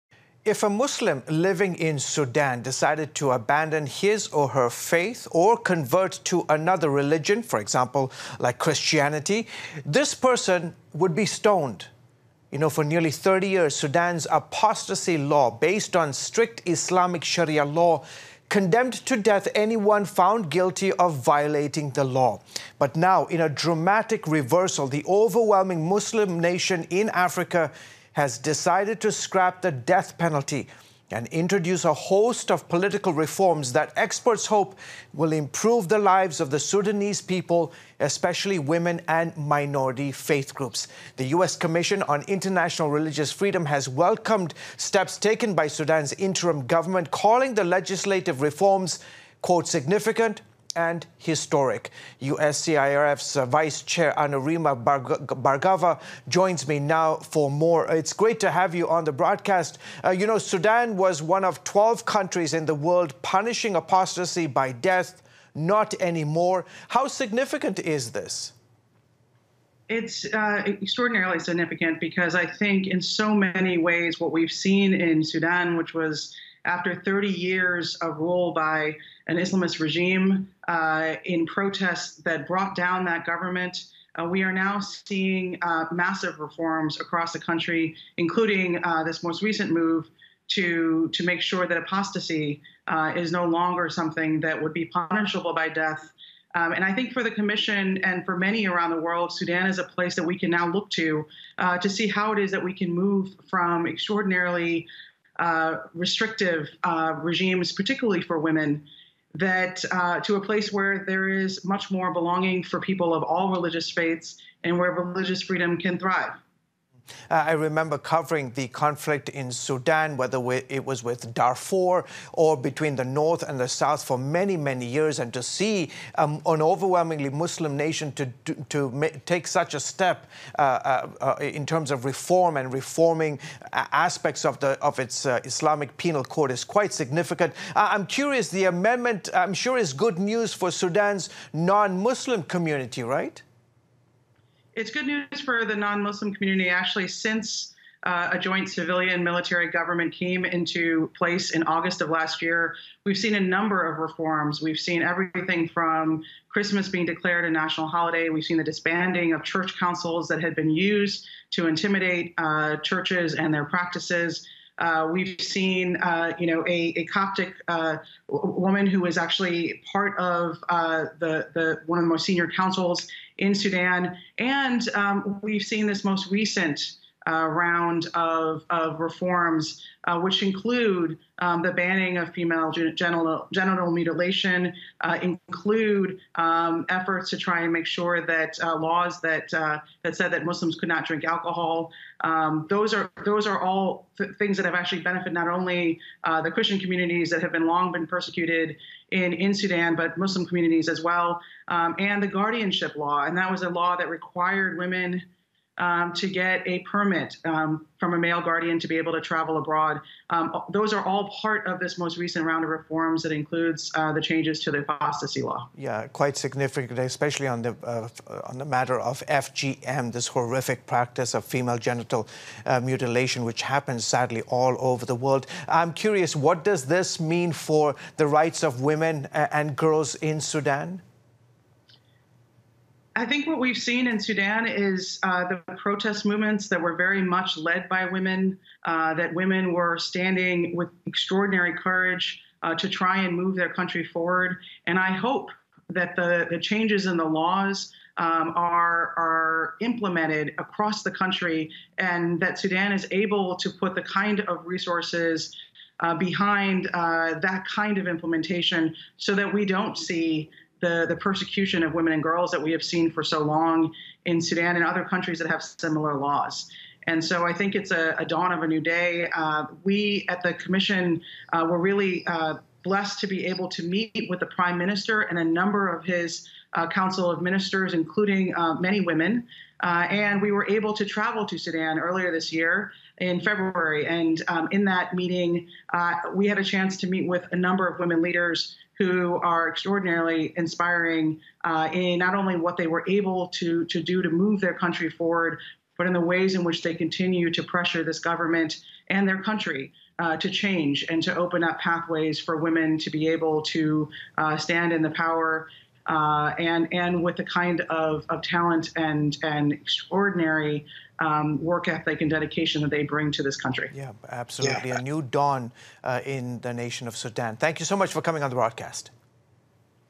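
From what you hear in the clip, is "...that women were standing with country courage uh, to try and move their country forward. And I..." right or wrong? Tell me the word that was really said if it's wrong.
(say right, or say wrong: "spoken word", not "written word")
wrong: "extraordinary", not "country".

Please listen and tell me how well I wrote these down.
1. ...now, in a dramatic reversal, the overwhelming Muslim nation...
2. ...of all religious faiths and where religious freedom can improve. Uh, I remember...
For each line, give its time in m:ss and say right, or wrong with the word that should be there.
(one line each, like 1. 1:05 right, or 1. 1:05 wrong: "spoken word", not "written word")
1. 0:22 right
2. 1:53 wrong: "thrive", not "improve".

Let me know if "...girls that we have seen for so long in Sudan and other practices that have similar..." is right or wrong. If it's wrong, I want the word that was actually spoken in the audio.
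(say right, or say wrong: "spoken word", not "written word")
wrong: "countries", not "practices".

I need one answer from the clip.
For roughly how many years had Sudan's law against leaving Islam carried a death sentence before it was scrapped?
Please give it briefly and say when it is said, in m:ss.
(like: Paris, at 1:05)
30 years, at 0:12.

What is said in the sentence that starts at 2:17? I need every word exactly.
I'm curious, the amendment, I'm sure, is good news for Sudan's non Muslim community, right?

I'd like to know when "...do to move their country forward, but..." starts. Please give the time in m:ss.
4:54.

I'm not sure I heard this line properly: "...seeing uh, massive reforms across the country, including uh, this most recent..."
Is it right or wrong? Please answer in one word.
right.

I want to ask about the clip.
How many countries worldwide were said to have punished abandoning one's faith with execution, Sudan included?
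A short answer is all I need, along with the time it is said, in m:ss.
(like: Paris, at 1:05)
12, at 1:01.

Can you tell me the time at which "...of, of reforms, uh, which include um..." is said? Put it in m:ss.
2:58.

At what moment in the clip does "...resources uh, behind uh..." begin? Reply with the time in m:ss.
4:14.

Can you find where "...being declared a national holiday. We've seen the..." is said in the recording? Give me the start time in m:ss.
2:36.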